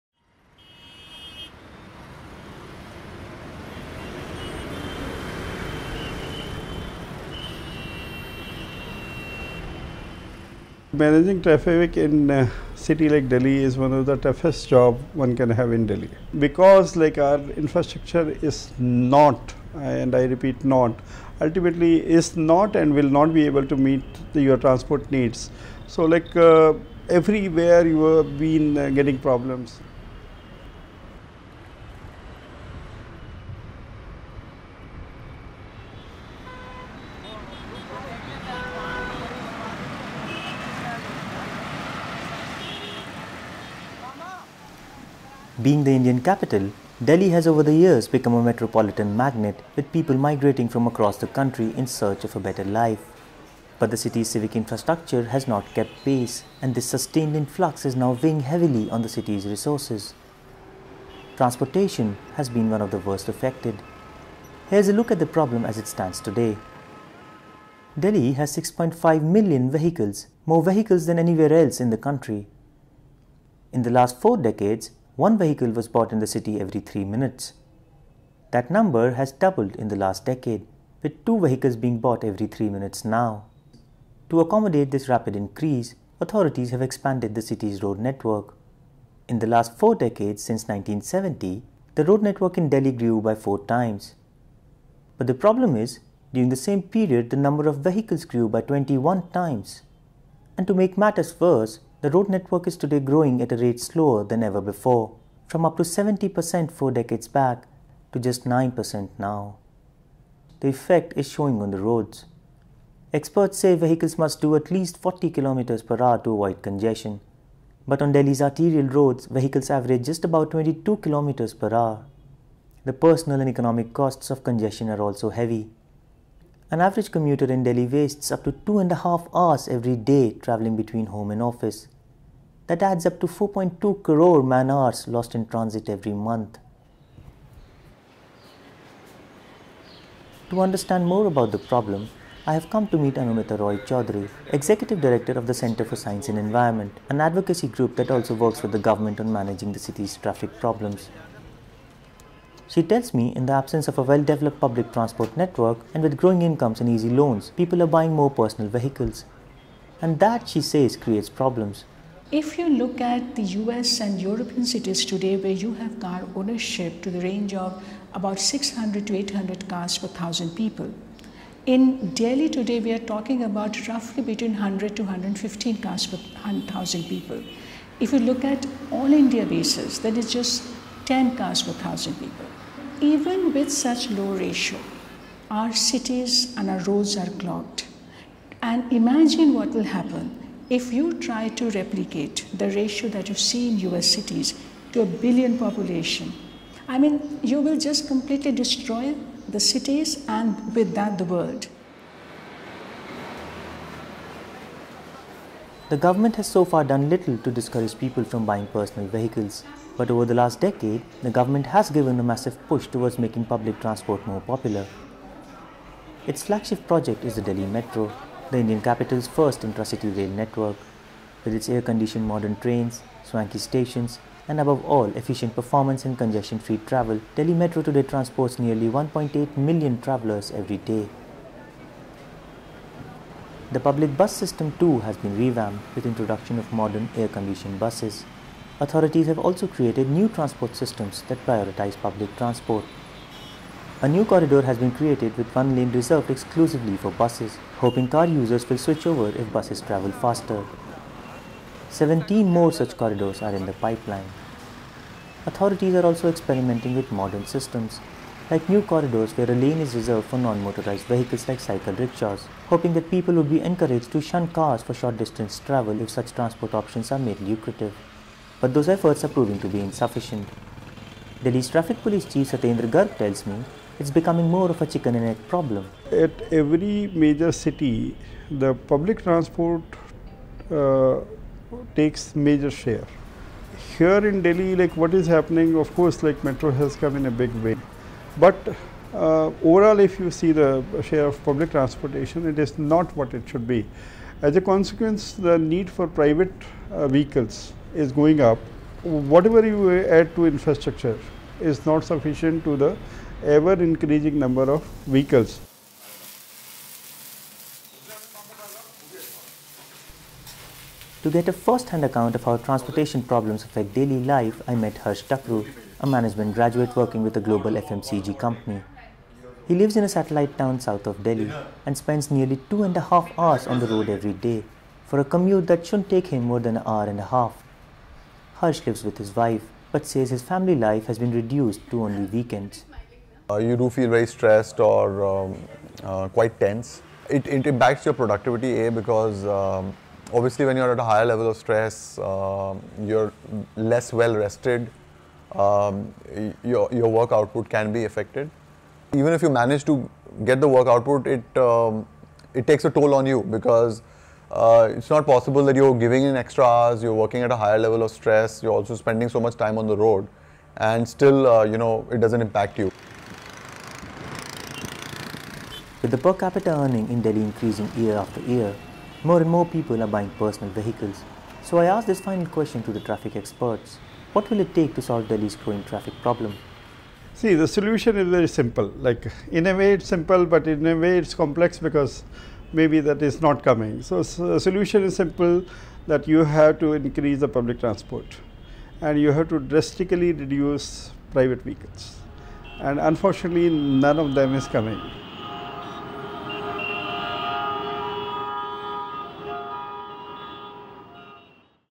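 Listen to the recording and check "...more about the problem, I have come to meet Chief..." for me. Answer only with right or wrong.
wrong.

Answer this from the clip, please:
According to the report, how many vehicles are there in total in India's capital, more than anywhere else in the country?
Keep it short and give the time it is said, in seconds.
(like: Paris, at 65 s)
6.5 million, at 68 s.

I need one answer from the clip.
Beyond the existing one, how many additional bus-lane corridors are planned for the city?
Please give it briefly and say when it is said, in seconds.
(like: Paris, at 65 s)
17, at 251 s.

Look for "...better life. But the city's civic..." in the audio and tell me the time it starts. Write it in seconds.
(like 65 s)
52 s.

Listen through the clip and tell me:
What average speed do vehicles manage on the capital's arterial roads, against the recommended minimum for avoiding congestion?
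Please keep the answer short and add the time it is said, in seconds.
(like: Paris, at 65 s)
22 km per hour, at 120 s.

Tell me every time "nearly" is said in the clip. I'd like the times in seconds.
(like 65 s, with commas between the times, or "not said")
228 s, 322 s.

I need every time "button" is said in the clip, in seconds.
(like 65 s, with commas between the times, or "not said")
not said.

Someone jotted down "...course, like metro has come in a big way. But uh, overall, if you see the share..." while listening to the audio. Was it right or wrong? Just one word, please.
right.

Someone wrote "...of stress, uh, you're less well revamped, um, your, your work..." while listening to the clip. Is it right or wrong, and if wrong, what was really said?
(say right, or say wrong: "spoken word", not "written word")
wrong: "rested", not "revamped".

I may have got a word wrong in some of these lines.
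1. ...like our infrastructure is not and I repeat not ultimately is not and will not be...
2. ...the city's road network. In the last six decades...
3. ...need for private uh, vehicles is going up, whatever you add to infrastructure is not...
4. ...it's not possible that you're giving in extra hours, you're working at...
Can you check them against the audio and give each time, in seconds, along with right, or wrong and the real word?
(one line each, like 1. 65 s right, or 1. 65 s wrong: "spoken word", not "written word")
1. 16 s right
2. 87 s wrong: "four", not "six"
3. 295 s right
4. 354 s right.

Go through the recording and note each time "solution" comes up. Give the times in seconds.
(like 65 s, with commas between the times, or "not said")
377 s, 384 s.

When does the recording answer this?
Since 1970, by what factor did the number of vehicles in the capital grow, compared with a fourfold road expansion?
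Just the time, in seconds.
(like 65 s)
98 s.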